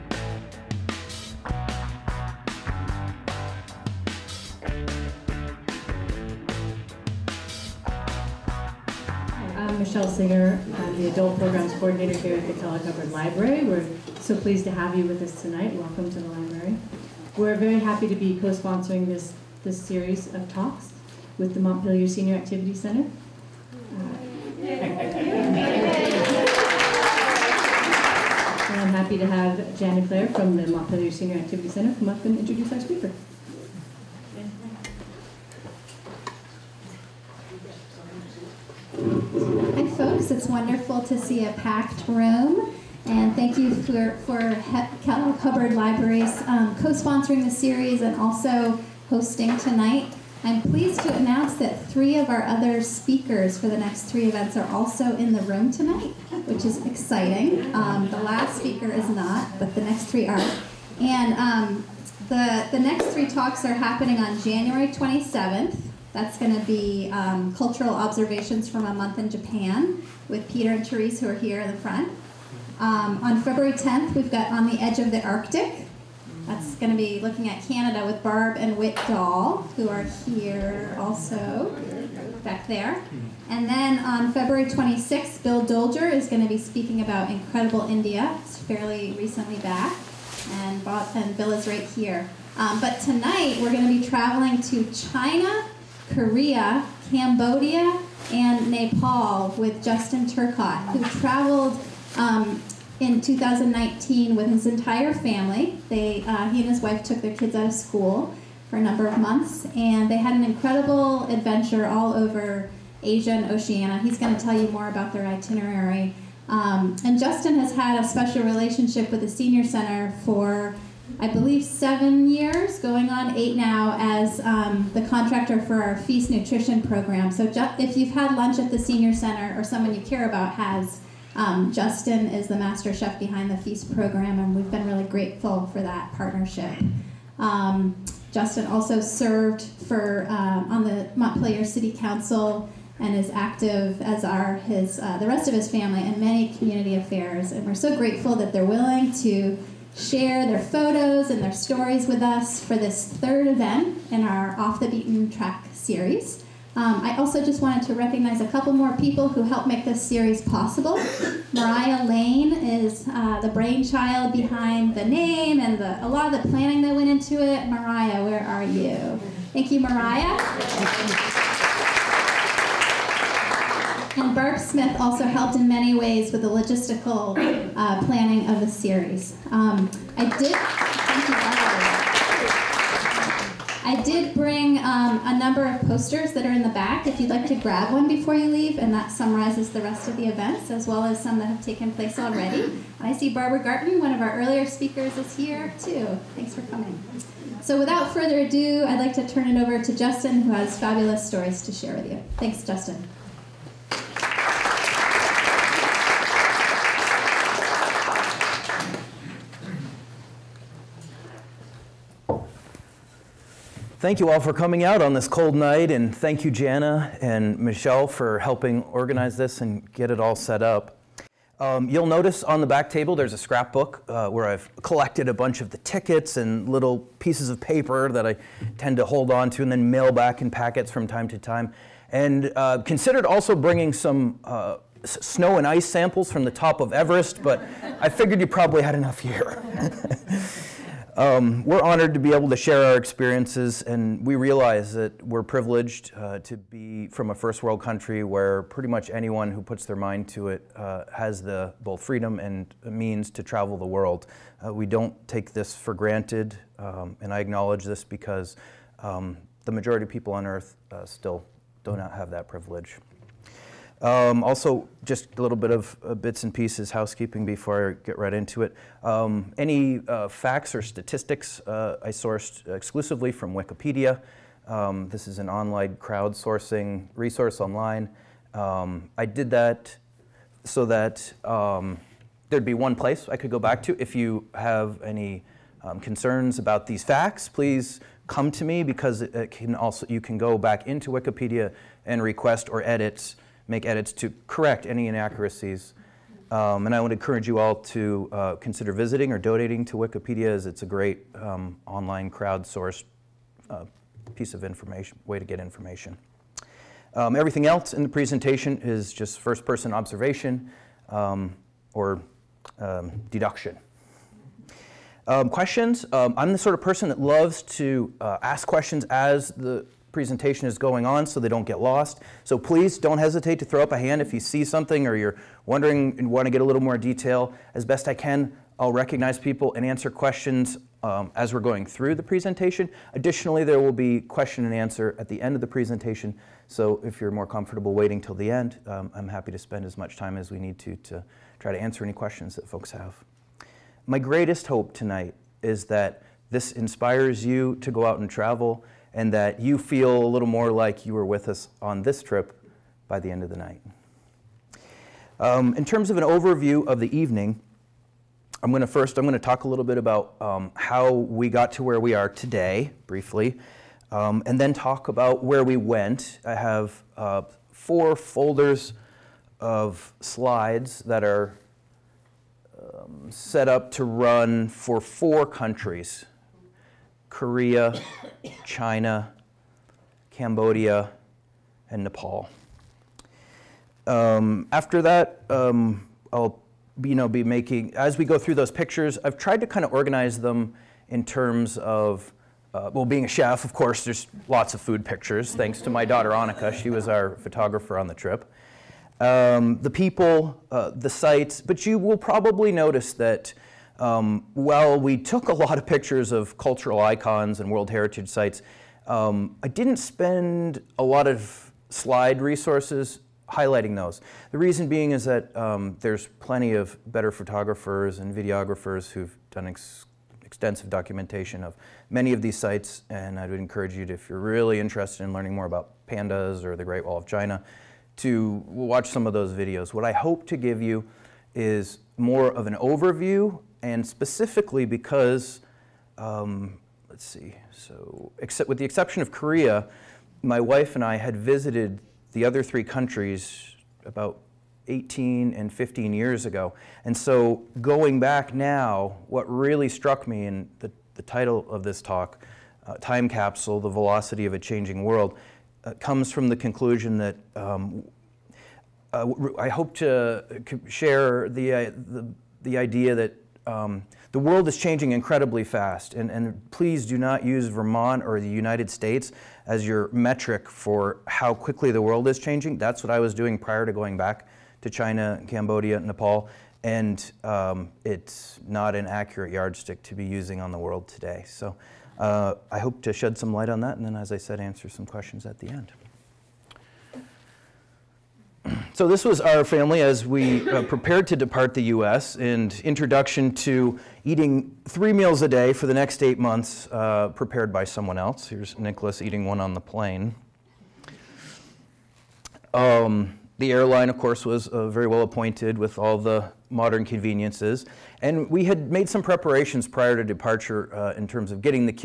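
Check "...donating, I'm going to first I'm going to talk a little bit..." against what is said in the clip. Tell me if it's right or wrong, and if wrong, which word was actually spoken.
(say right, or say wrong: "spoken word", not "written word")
wrong: "evening", not "donating".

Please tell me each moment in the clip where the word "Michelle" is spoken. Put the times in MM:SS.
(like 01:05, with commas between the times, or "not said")
00:09, 03:37.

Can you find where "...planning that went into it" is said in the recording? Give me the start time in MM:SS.
02:46.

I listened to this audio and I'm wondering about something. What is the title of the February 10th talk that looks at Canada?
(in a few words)
On the Edge of the Arctic.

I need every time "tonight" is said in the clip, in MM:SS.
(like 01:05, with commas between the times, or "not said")
00:15, 00:49, 00:55, 01:33, 05:44.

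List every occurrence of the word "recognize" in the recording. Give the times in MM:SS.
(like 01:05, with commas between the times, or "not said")
02:37, 05:28.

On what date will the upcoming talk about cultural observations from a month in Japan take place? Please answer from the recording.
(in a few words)
January 27.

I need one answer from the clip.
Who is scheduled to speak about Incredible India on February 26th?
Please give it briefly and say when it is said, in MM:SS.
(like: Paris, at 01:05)
Bill Dolger, at 01:25.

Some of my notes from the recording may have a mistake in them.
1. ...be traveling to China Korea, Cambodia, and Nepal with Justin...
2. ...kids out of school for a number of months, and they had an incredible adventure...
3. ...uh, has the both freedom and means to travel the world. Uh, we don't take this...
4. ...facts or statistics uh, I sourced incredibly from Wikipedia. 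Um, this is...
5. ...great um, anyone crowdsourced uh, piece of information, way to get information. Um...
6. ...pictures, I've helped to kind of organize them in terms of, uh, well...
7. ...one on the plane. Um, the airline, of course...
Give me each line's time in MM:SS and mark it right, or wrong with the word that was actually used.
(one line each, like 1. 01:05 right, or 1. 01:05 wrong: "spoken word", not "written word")
1. 01:33 right
2. 01:47 right
3. 04:10 right
4. 04:30 wrong: "exclusively", not "incredibly"
5. 05:00 wrong: "online", not "anyone"
6. 06:28 wrong: "tried", not "helped"
7. 08:19 right.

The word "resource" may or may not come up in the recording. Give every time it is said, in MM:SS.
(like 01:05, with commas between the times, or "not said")
04:37, 06:52.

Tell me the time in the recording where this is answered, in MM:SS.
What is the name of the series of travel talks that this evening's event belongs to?
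02:34.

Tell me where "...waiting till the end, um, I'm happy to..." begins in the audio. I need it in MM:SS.
05:37.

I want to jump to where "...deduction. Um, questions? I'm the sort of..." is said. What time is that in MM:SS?
05:13.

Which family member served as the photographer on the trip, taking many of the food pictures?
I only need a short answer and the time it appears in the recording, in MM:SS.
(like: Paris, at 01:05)
Annika, at 06:36.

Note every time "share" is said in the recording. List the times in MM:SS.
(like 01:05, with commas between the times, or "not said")
02:29, 03:21, 04:02, 07:40.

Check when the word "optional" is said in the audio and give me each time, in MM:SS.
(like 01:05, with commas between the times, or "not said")
not said.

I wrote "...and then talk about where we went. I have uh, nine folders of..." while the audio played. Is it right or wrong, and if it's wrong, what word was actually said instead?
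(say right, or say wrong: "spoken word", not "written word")
wrong: "four", not "nine".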